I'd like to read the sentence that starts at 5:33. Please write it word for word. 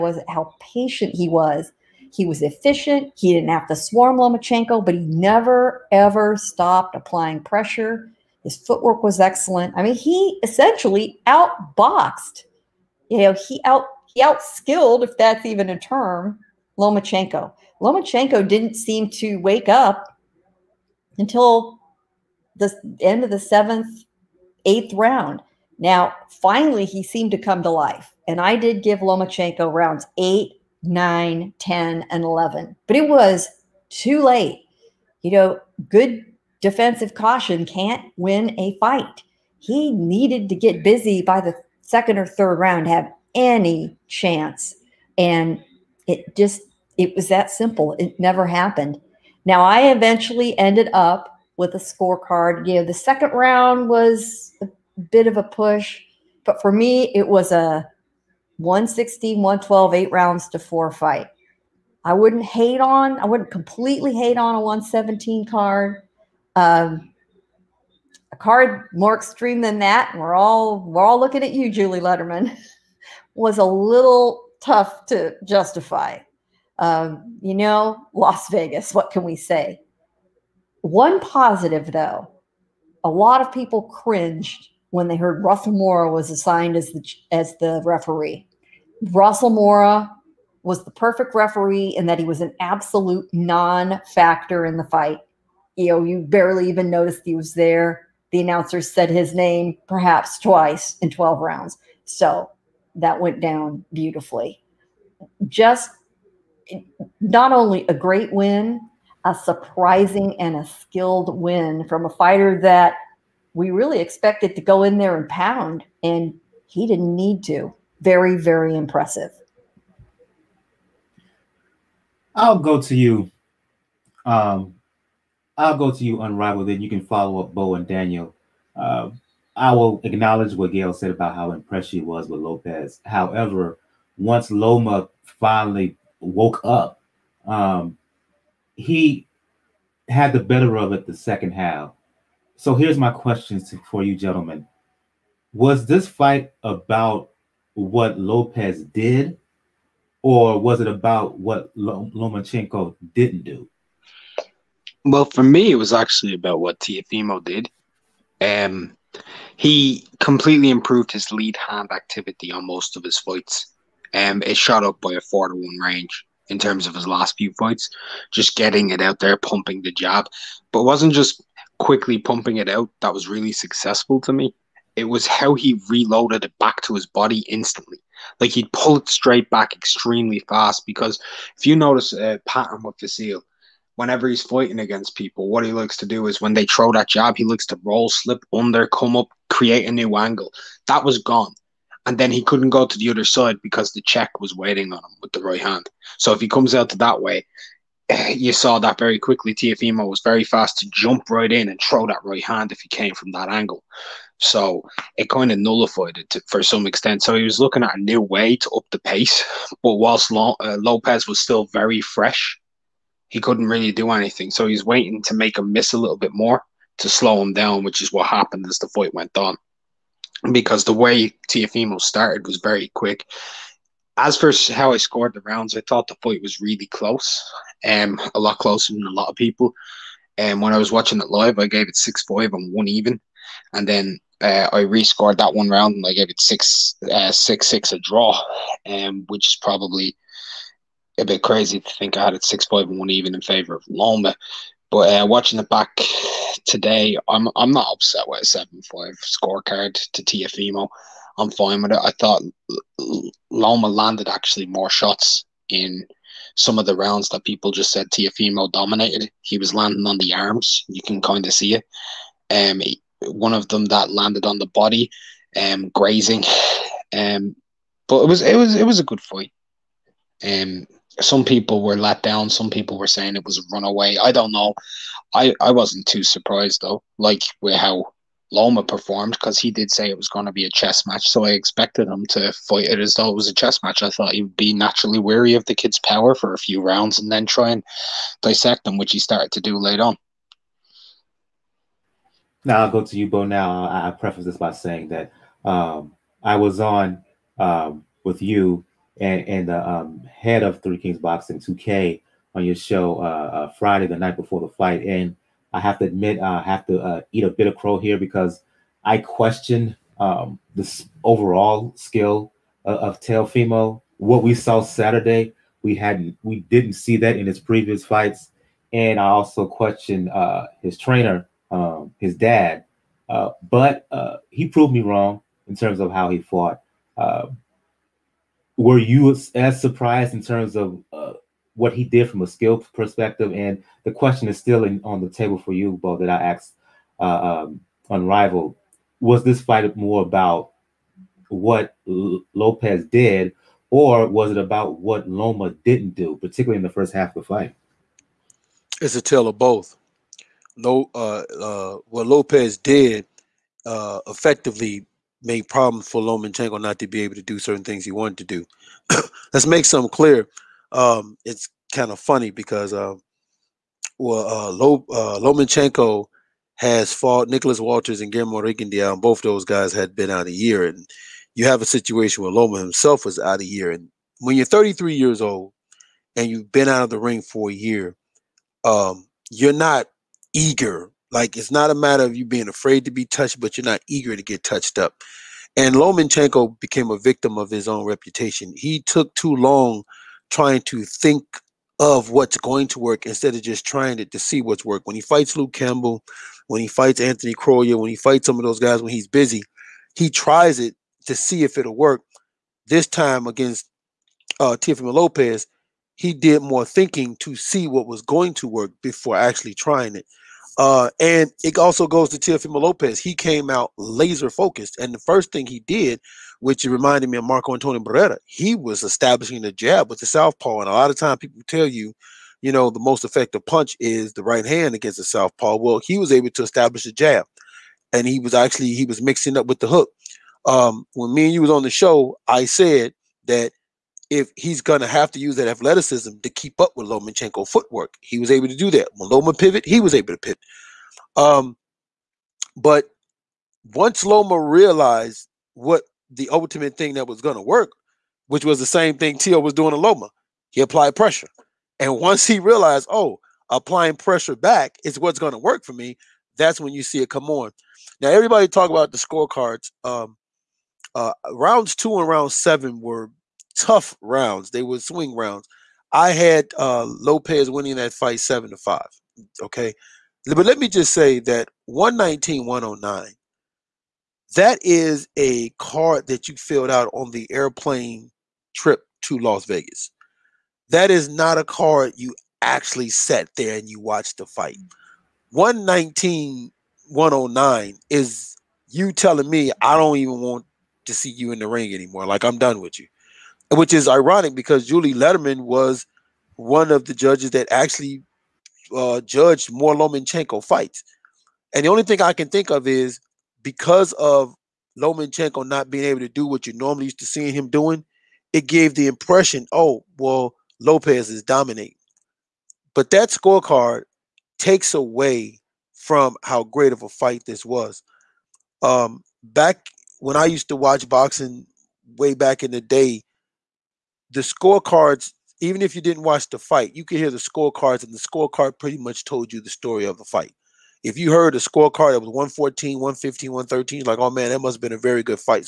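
And the question is still in, on the table for you, Bo, that I asked uh, um, Unrivaled.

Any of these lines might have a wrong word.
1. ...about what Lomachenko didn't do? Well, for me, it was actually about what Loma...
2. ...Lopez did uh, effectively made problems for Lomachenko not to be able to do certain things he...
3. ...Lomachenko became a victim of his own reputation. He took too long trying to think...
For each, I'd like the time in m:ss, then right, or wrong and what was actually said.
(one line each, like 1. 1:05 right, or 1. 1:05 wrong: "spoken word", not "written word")
1. 2:30 wrong: "Teofimo", not "Loma"
2. 5:52 right
3. 6:25 right.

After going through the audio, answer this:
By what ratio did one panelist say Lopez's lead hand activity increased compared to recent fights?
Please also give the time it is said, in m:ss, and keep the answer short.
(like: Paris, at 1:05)
4 to 1, at 2:45.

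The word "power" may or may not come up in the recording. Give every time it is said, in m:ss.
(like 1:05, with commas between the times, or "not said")
4:45.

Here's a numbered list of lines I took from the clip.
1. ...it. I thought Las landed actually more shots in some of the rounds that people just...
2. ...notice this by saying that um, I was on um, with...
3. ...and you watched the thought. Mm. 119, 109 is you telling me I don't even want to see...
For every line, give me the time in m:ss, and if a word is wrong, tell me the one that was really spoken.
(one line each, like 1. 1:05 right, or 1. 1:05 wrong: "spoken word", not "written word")
1. 4:11 wrong: "Loma", not "Las"
2. 4:54 wrong: "preface", not "notice"
3. 8:03 wrong: "fight", not "thought".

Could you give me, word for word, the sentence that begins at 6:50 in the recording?
Uh, and it also goes to Teofimo Lopez.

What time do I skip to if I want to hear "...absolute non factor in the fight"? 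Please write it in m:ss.
1:32.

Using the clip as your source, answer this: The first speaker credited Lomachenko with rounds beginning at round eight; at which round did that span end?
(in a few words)
11.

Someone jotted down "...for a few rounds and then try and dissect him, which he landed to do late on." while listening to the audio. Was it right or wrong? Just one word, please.
wrong.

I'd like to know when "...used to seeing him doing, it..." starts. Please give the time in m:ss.
8:27.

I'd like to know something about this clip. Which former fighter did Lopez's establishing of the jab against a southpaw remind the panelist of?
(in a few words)
Marco Antonio Barrera.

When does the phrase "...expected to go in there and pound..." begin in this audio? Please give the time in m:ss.
1:53.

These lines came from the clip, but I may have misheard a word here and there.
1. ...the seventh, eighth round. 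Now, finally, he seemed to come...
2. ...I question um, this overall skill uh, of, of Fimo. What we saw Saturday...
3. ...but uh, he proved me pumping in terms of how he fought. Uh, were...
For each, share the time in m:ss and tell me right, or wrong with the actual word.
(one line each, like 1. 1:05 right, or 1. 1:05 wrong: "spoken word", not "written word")
1. 0:23 right
2. 5:09 right
3. 5:23 wrong: "wrong", not "pumping".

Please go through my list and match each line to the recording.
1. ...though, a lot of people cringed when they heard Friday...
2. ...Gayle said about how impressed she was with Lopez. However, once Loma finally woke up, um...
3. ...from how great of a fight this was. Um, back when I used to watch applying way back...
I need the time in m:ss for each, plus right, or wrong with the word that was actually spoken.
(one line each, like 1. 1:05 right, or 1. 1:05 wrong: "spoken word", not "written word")
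1. 1:21 wrong: "Russell", not "Friday"
2. 2:10 right
3. 8:35 wrong: "boxing", not "applying".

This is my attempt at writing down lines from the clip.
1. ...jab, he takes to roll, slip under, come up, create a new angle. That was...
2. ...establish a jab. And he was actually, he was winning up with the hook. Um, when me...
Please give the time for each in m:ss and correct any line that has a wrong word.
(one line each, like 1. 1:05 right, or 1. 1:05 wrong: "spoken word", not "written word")
1. 3:07 wrong: "likes", not "takes"
2. 7:06 wrong: "mixing", not "winning".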